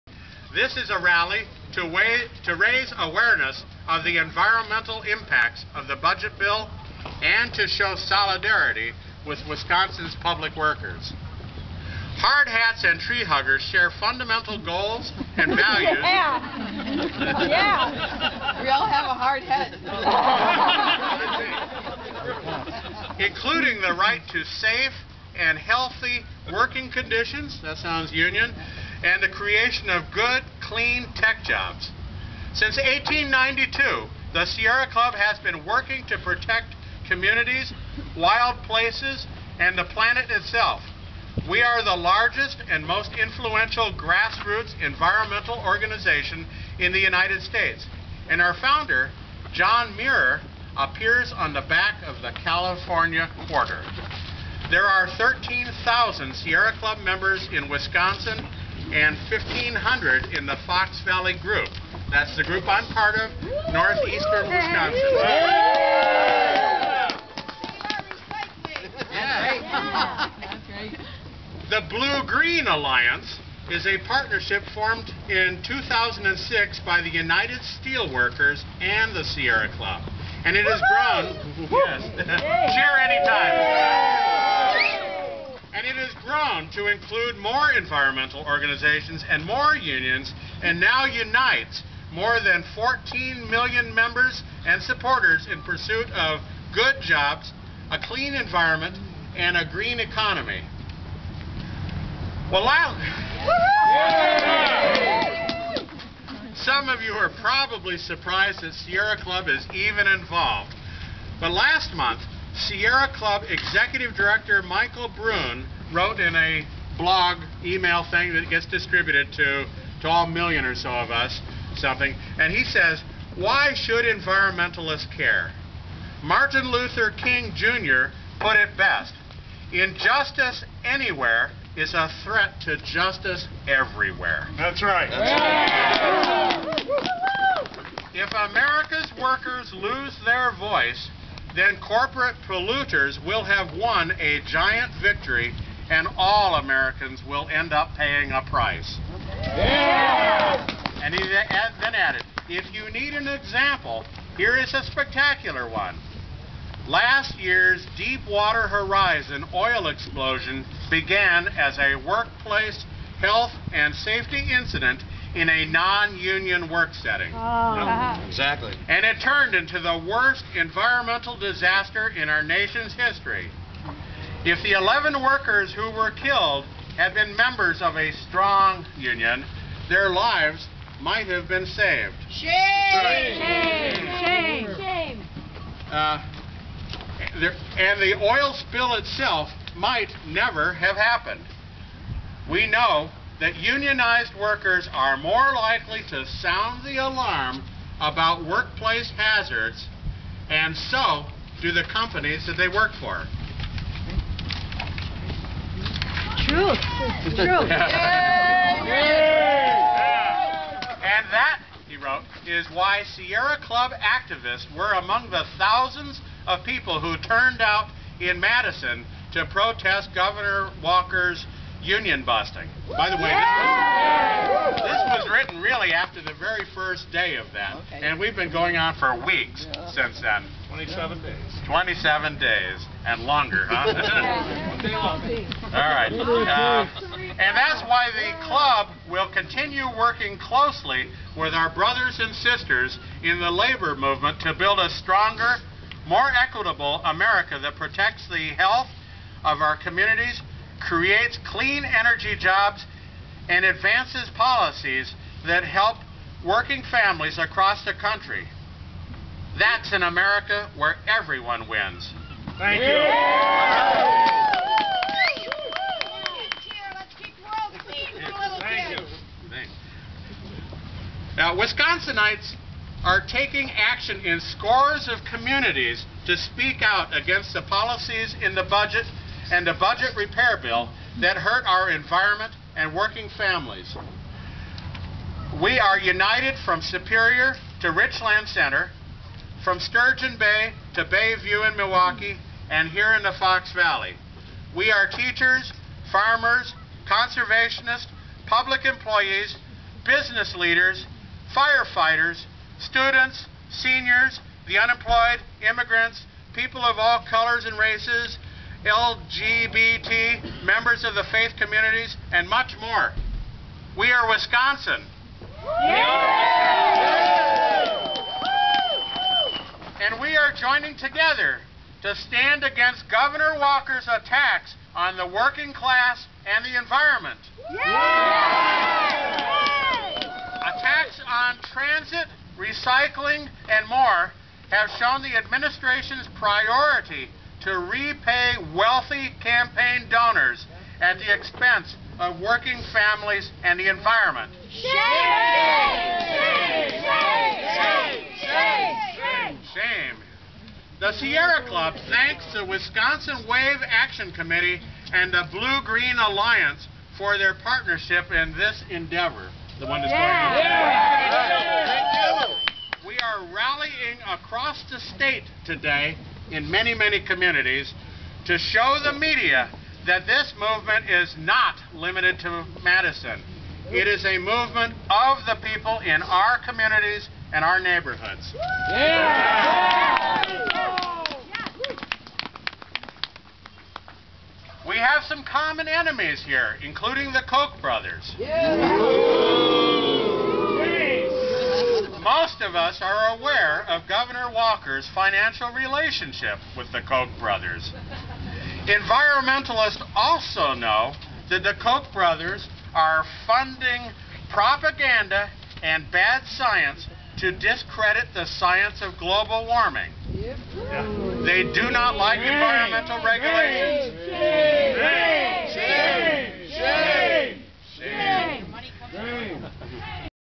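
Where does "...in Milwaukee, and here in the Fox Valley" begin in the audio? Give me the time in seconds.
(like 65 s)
291 s.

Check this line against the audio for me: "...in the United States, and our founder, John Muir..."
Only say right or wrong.
right.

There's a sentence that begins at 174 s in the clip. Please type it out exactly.
If the 11 workers who were killed had been members of a strong union, their lives might have been saved.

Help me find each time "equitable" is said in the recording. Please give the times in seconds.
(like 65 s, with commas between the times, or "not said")
246 s.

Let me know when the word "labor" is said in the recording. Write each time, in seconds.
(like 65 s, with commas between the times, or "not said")
243 s.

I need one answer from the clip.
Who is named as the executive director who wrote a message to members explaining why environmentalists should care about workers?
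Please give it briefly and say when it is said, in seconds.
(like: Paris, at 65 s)
Michael Brune, at 114 s.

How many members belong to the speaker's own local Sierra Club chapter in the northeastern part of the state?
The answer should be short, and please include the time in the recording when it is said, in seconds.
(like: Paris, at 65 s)
1,500, at 59 s.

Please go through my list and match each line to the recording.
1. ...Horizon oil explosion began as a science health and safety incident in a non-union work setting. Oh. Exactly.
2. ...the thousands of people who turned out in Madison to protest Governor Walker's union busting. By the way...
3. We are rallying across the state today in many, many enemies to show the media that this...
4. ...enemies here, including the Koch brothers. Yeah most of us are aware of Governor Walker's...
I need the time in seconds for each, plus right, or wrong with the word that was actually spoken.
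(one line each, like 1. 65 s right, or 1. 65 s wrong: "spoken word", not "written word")
1. 158 s wrong: "workplace", not "science"
2. 215 s right
3. 363 s wrong: "communities", not "enemies"
4. 385 s right.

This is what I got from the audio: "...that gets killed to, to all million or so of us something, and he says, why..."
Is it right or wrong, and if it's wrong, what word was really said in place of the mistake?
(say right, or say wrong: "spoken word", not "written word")
wrong: "distributed", not "killed".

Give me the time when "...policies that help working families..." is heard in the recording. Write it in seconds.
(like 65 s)
254 s.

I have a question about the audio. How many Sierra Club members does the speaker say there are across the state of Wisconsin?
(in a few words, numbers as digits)
13,000.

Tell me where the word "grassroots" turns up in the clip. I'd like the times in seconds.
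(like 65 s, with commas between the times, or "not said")
43 s.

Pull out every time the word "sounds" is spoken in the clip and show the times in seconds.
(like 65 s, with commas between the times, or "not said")
27 s, 196 s.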